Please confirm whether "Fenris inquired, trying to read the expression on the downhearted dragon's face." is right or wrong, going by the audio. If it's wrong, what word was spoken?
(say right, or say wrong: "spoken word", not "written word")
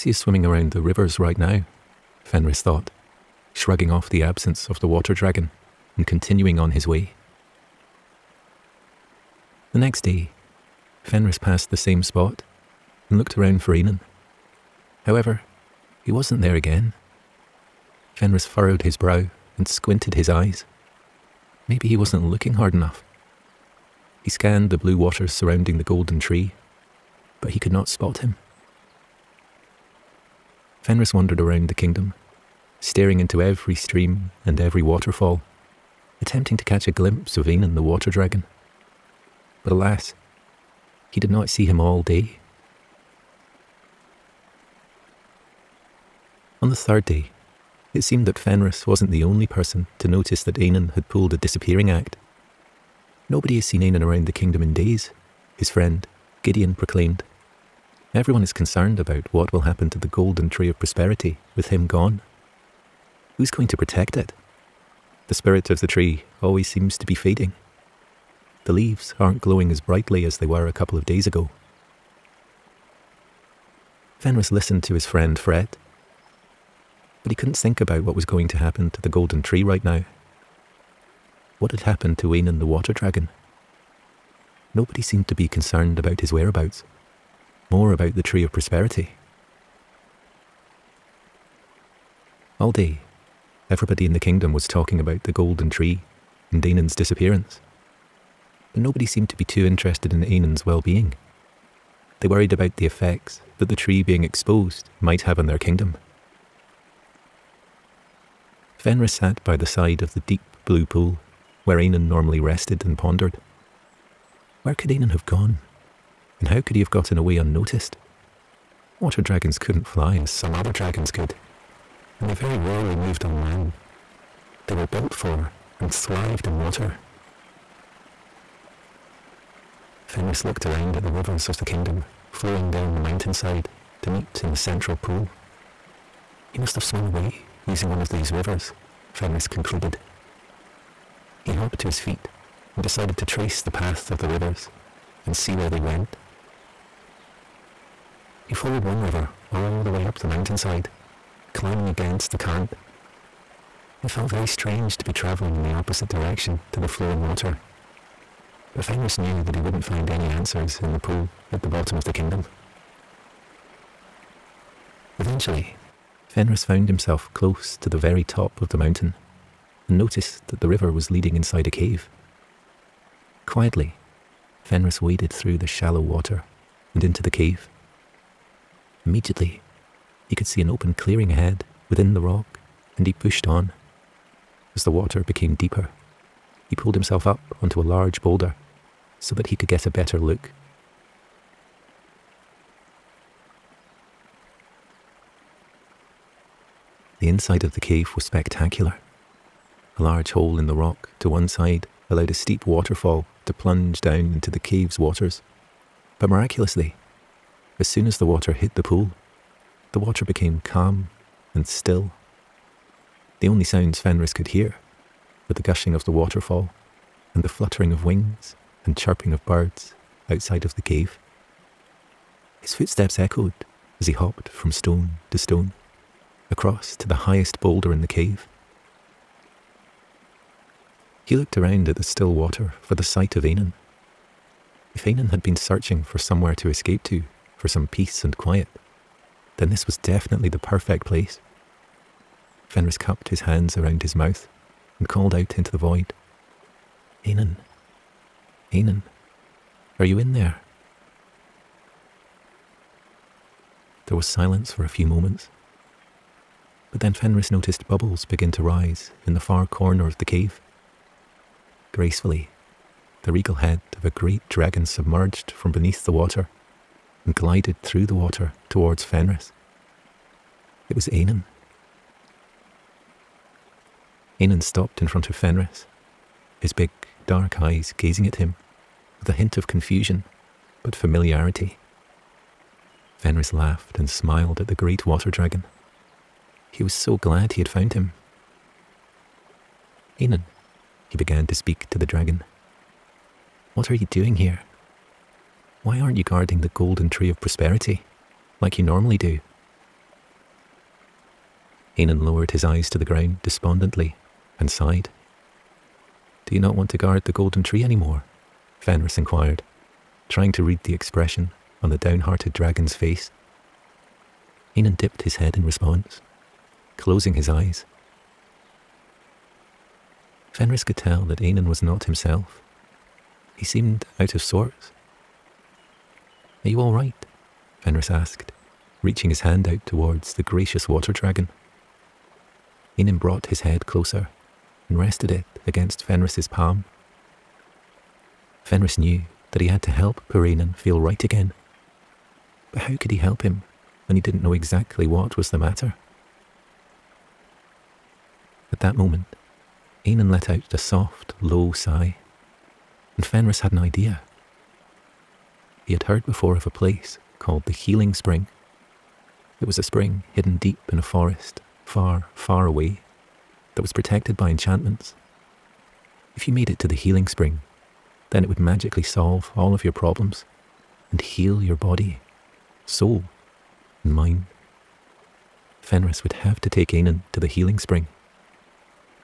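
right.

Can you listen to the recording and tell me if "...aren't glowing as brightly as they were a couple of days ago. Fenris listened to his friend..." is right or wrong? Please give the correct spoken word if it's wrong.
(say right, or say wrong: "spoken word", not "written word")
right.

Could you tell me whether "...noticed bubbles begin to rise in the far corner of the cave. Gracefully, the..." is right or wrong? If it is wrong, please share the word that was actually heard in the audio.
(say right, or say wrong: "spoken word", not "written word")
right.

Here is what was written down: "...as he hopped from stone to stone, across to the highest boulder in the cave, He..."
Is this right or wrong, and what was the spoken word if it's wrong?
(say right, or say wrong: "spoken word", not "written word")
right.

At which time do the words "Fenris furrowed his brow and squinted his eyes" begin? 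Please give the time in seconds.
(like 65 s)
18 s.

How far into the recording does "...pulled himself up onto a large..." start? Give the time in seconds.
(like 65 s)
186 s.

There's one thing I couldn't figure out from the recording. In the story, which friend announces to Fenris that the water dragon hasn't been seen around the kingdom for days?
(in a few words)
Gideon.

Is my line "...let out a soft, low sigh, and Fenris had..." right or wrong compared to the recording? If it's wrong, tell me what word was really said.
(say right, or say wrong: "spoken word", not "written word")
right.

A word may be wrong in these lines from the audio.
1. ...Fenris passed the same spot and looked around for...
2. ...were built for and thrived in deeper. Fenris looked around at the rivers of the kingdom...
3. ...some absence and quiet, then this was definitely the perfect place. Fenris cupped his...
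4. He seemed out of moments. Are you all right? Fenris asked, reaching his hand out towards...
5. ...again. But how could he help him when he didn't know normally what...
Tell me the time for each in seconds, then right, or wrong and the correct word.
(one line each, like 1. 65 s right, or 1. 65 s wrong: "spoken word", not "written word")
1. 11 s right
2. 124 s wrong: "water", not "deeper"
3. 237 s wrong: "peace", not "absence"
4. 323 s wrong: "sorts", not "moments"
5. 341 s wrong: "exactly", not "normally".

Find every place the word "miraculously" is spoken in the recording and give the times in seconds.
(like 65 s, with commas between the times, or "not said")
206 s.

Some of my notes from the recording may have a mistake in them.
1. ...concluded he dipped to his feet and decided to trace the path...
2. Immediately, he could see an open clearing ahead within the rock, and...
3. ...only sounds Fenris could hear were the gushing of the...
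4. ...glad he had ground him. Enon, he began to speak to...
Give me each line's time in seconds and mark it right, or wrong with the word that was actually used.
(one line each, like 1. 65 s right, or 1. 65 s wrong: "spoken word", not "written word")
1. 139 s wrong: "hopped", not "dipped"
2. 179 s right
3. 213 s right
4. 287 s wrong: "found", not "ground".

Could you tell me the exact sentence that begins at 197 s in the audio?
The inside of the cave was spectacular.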